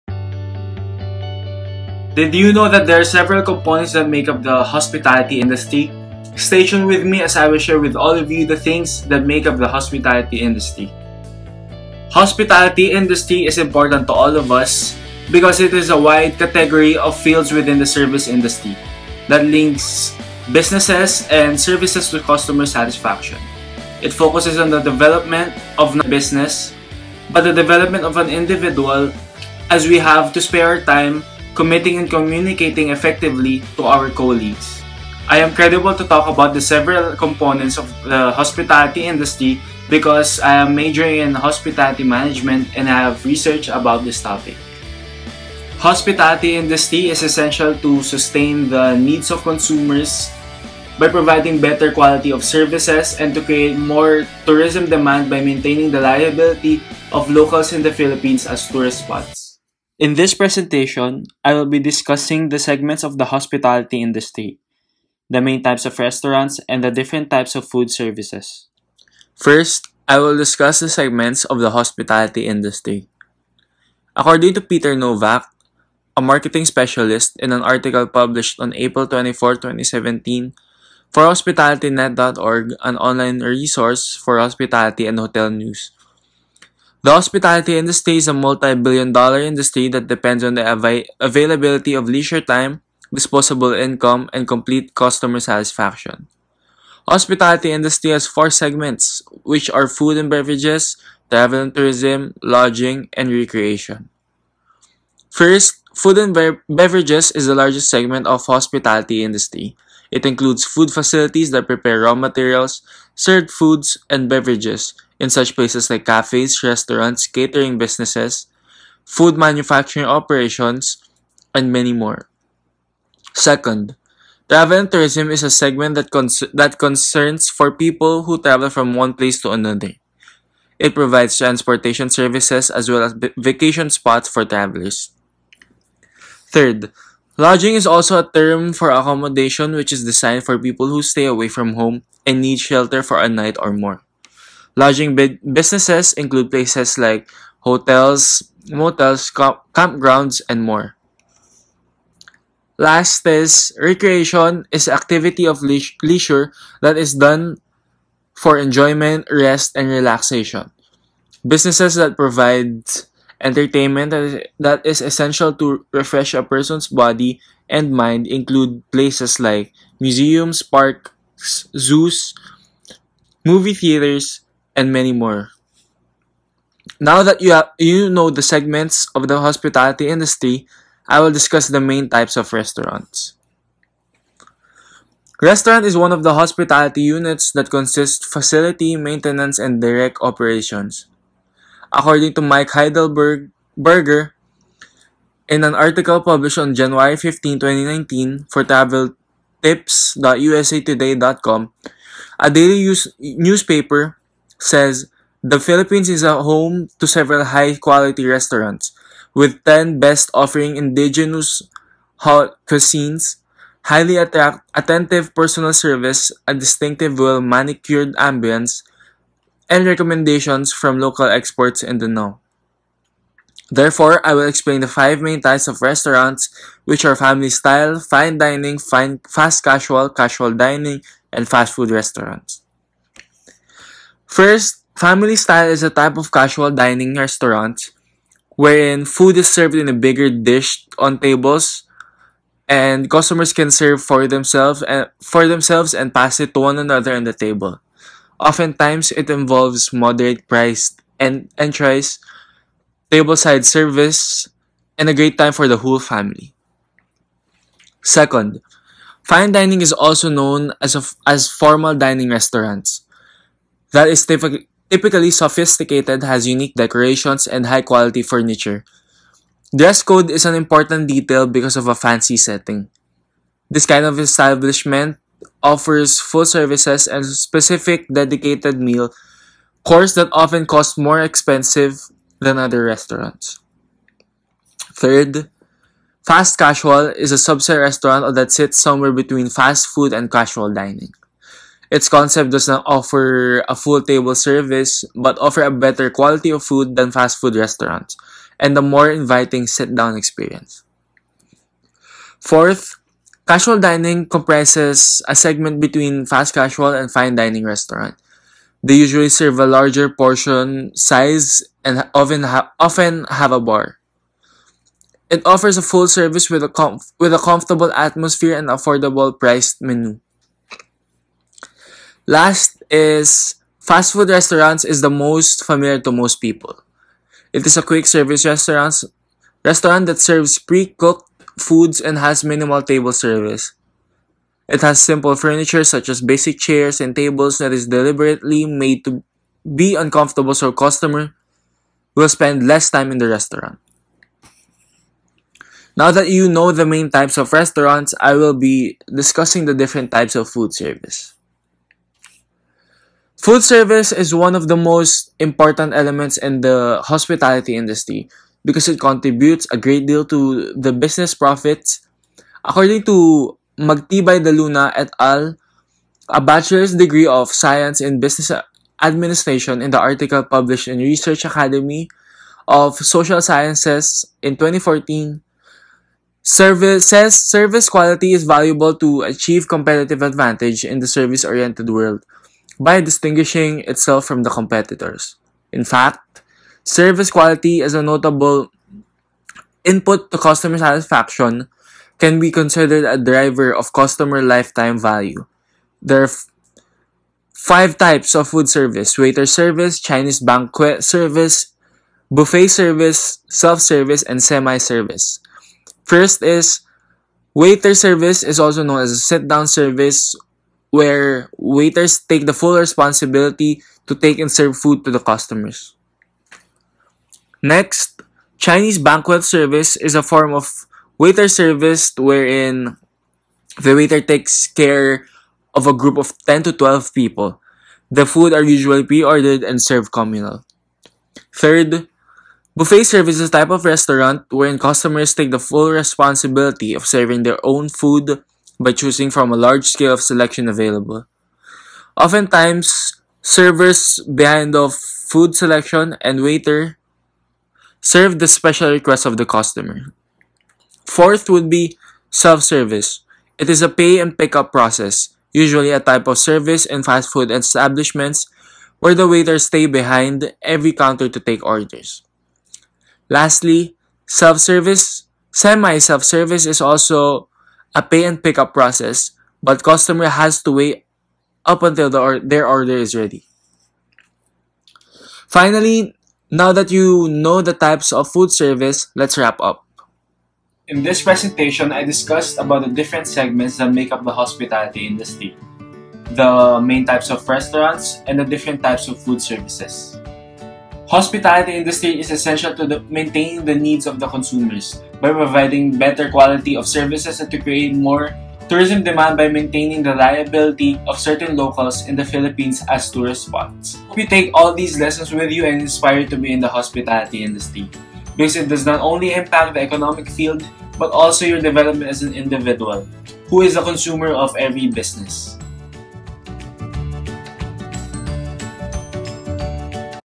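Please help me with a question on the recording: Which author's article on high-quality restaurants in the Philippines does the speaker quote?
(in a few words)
Mike Heidelberger.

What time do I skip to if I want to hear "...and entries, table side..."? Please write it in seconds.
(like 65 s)
251 s.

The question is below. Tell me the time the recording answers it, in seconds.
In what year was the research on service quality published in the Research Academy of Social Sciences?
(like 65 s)
374 s.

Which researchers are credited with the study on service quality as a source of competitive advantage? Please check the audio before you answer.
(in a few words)
Magtibay de Luna et al.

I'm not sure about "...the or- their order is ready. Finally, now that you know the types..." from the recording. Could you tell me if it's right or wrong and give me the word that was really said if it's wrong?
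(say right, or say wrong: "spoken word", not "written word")
right.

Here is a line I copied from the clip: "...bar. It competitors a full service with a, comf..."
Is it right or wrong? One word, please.
wrong.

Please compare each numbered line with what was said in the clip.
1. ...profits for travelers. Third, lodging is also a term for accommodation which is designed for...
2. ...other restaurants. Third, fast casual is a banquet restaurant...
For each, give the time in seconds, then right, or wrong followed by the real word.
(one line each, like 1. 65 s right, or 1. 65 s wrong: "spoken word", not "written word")
1. 133 s wrong: "spots", not "profits"
2. 282 s wrong: "subset", not "banquet".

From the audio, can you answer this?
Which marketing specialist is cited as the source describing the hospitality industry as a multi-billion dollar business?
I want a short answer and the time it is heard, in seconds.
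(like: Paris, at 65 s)
Peter Novak, at 74 s.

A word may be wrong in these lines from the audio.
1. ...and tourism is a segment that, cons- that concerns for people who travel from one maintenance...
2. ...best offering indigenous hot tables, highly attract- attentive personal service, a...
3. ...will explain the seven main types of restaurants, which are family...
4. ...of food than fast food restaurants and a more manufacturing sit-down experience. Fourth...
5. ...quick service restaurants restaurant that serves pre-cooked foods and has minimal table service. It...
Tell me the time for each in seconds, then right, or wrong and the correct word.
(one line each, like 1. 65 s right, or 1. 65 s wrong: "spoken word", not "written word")
1. 124 s wrong: "place", not "maintenance"
2. 209 s wrong: "cuisines", not "tables"
3. 224 s wrong: "five", not "seven"
4. 296 s wrong: "inviting", not "manufacturing"
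5. 327 s right.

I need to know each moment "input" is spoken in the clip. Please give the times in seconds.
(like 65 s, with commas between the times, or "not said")
389 s.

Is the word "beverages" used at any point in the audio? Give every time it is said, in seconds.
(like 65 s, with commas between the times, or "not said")
100 s, 106 s, 114 s.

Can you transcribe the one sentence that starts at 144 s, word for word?
Lodging businesses include places like hotels, motels, campgrounds, and more.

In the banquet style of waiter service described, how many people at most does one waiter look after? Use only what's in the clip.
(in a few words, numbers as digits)
12.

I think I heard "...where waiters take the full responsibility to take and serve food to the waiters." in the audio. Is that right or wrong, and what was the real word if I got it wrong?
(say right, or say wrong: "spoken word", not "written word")
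wrong: "customers", not "waiters".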